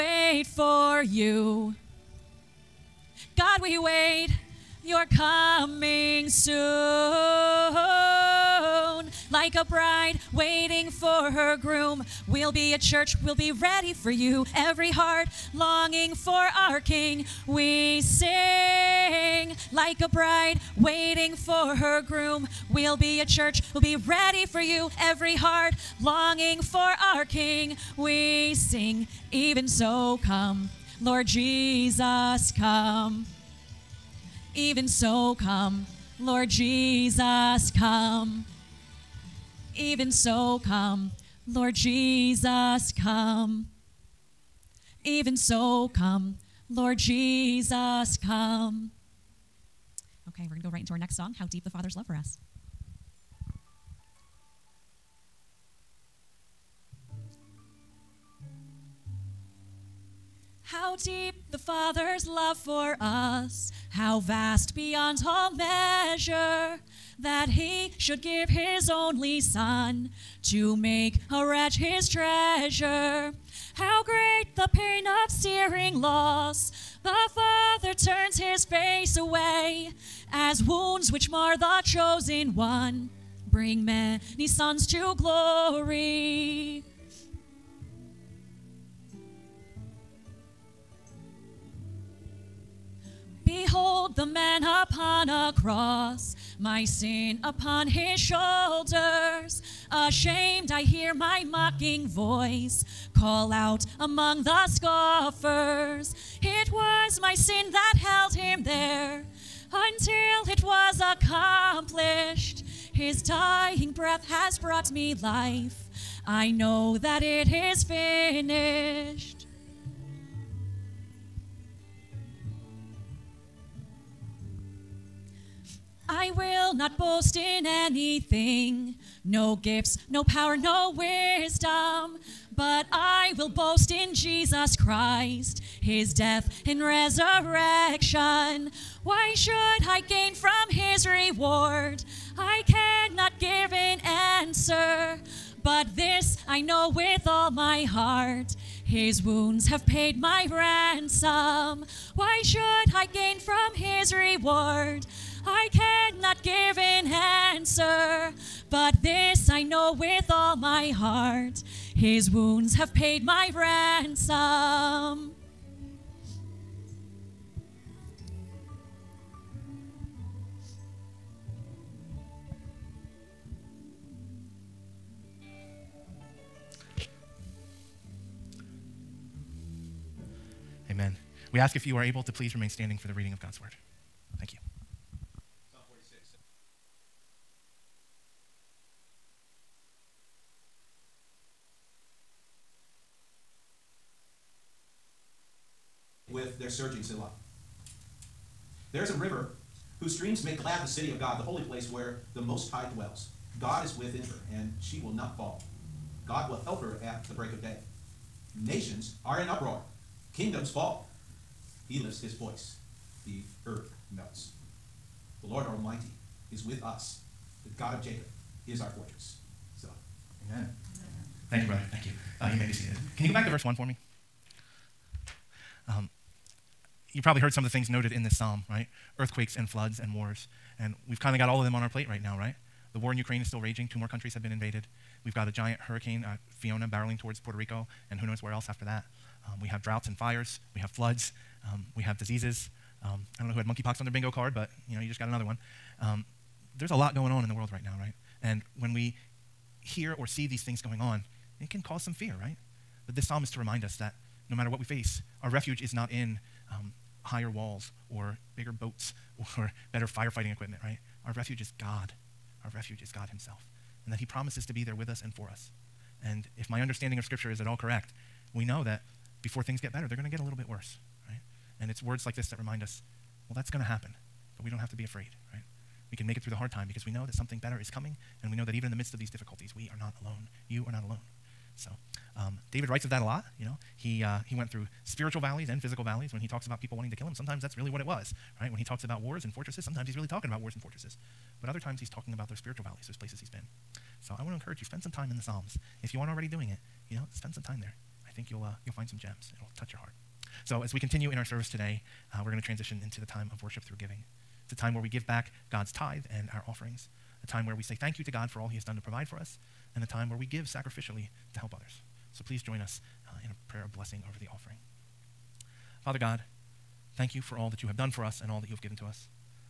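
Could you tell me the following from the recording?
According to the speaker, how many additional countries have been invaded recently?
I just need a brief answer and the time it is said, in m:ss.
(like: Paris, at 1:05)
2, at 3:53.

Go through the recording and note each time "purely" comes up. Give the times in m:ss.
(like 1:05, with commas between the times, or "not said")
not said.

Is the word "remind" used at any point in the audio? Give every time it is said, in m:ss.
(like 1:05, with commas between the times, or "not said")
4:13, 4:32.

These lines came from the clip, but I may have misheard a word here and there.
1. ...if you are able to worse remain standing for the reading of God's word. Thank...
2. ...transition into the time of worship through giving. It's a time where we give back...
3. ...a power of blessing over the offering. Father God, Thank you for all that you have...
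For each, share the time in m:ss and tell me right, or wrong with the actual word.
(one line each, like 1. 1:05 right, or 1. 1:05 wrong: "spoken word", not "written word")
1. 3:01 wrong: "please", not "worse"
2. 5:02 right
3. 5:13 wrong: "prayer", not "power".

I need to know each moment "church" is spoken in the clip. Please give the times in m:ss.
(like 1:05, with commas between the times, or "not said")
0:12, 0:23.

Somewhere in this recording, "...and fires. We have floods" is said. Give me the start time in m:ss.
4:00.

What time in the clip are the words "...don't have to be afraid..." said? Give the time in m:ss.
4:34.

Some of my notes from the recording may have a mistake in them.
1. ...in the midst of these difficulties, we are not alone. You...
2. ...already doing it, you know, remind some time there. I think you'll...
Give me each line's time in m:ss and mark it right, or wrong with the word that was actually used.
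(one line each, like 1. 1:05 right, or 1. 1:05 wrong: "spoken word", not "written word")
1. 4:38 right
2. 4:56 wrong: "spend", not "remind".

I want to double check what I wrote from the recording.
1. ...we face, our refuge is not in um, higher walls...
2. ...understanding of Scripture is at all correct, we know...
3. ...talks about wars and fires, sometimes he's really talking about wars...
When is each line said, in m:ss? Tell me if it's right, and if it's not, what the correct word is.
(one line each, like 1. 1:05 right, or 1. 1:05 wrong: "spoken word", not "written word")
1. 4:14 right
2. 4:26 right
3. 4:48 wrong: "fortresses", not "fires".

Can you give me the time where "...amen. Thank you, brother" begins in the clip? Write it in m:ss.
3:40.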